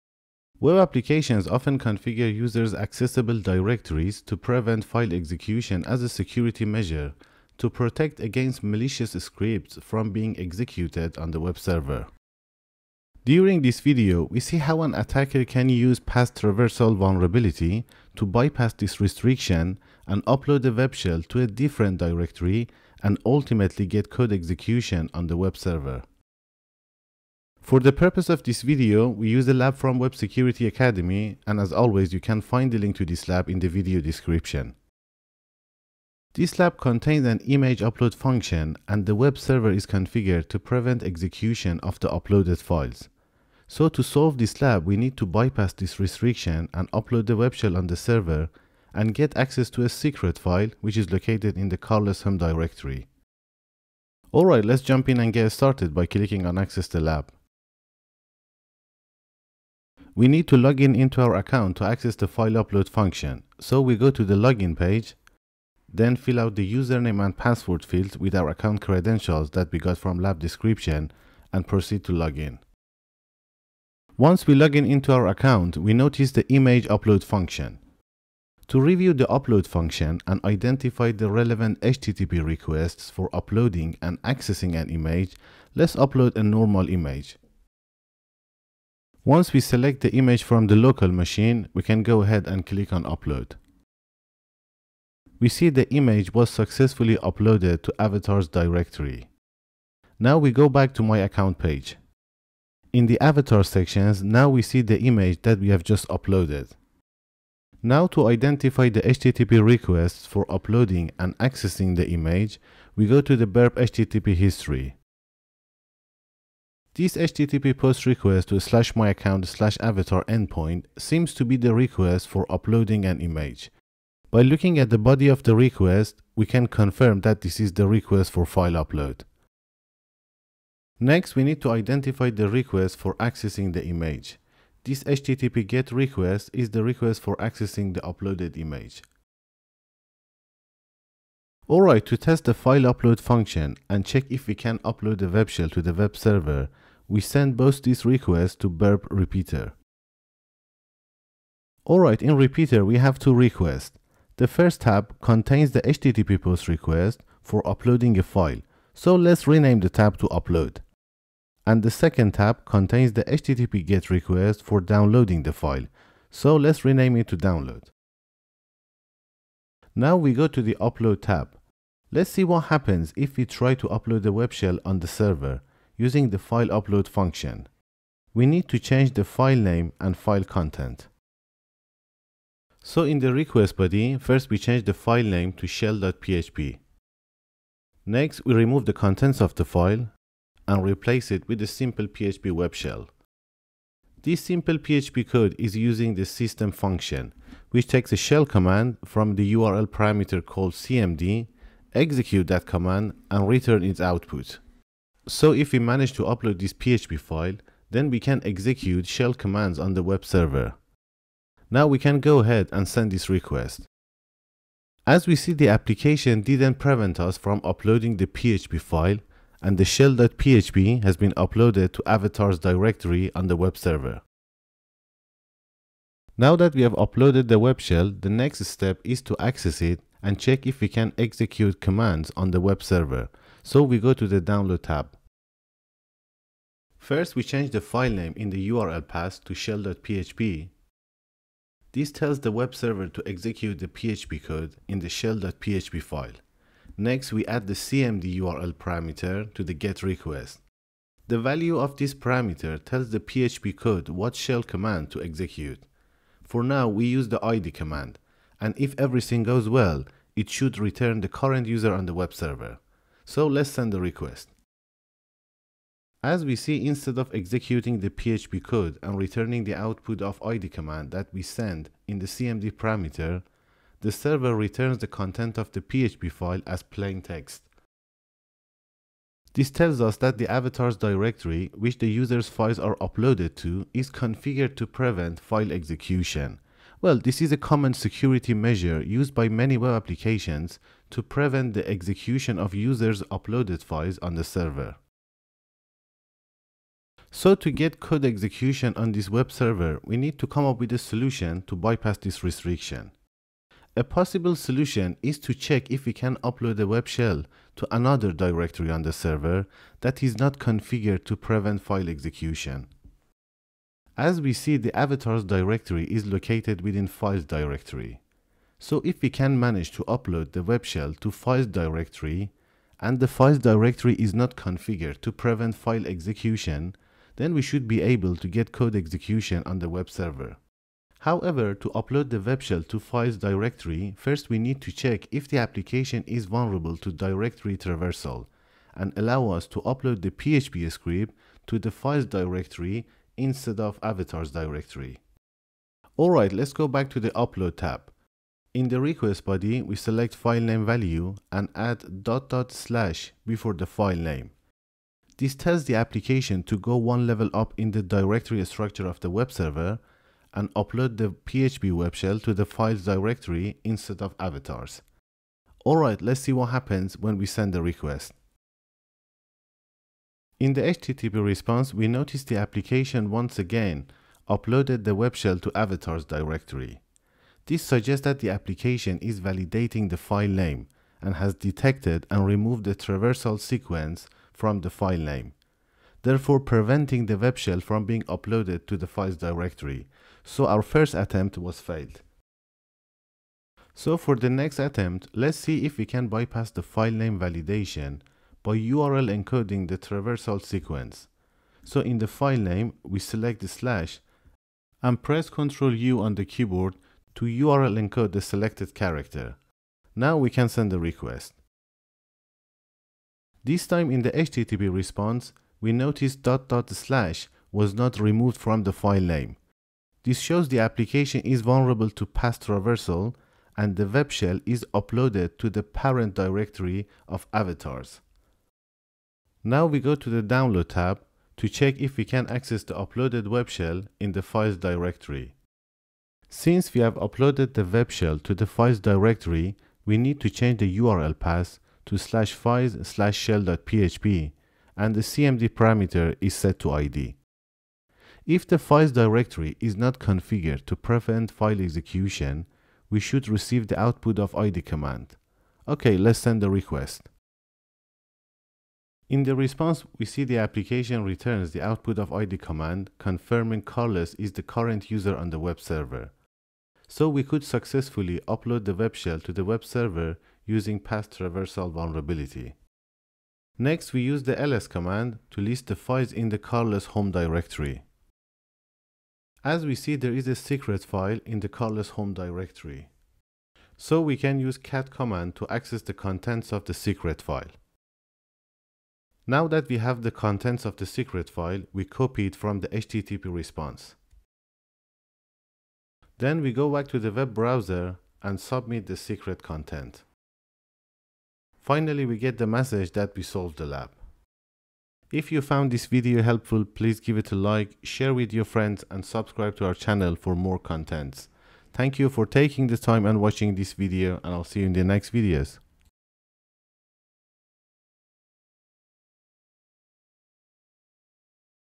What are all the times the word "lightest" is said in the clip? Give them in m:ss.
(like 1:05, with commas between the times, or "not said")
not said.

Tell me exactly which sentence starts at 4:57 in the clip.
So to get code execution on this web server, we need to come up with a solution to bypass this restriction.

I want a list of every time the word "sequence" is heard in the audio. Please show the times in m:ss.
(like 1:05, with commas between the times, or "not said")
6:23, 6:40.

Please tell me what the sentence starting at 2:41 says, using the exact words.
And the second tab contains the HTTP GET request for downloading the file, so let's rename it to download.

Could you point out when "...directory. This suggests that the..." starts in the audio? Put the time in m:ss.
6:16.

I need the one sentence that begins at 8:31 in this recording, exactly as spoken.
Thank you for taking the time and watching this video and I'll see you in the next videos.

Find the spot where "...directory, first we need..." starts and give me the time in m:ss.
5:33.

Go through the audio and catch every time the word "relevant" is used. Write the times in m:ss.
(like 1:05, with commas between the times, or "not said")
1:21.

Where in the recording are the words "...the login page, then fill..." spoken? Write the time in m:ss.
1:04.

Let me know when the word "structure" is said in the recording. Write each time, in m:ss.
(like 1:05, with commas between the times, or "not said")
5:58.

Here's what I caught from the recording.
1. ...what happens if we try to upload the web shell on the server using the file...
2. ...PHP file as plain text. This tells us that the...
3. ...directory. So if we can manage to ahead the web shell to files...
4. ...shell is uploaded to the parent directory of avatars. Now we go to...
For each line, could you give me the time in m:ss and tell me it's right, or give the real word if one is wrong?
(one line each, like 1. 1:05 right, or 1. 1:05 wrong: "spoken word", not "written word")
1. 2:52 right
2. 4:35 right
3. 5:17 wrong: "upload", not "ahead"
4. 7:04 right.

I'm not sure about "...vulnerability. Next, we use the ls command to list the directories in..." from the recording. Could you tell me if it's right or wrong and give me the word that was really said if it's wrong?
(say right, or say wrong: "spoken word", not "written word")
wrong: "files", not "directories".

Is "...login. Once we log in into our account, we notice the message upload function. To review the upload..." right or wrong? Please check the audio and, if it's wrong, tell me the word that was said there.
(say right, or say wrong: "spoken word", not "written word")
wrong: "image", not "message".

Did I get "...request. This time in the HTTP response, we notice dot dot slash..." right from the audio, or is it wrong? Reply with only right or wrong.
right.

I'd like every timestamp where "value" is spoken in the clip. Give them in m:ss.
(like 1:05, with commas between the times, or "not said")
4:11, 5:50.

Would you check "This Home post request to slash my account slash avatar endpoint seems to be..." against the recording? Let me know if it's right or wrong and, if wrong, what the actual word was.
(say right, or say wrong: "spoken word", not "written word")
wrong: "HTTP", not "Home".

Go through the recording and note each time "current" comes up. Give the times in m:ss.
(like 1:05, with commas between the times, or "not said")
4:21, 7:44.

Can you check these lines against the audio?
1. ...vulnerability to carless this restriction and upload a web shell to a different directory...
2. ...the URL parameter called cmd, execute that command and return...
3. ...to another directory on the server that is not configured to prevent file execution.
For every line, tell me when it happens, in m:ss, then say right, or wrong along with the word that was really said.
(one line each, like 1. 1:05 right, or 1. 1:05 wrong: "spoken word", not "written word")
1. 0:16 wrong: "bypass", not "carless"
2. 3:19 right
3. 5:07 right.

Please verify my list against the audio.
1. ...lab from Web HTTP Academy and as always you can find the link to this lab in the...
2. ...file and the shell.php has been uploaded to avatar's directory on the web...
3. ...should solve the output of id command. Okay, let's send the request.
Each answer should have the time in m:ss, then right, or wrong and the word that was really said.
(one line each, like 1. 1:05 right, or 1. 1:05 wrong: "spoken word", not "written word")
1. 0:29 wrong: "Security", not "HTTP"
2. 3:38 right
3. 7:33 wrong: "receive", not "solve".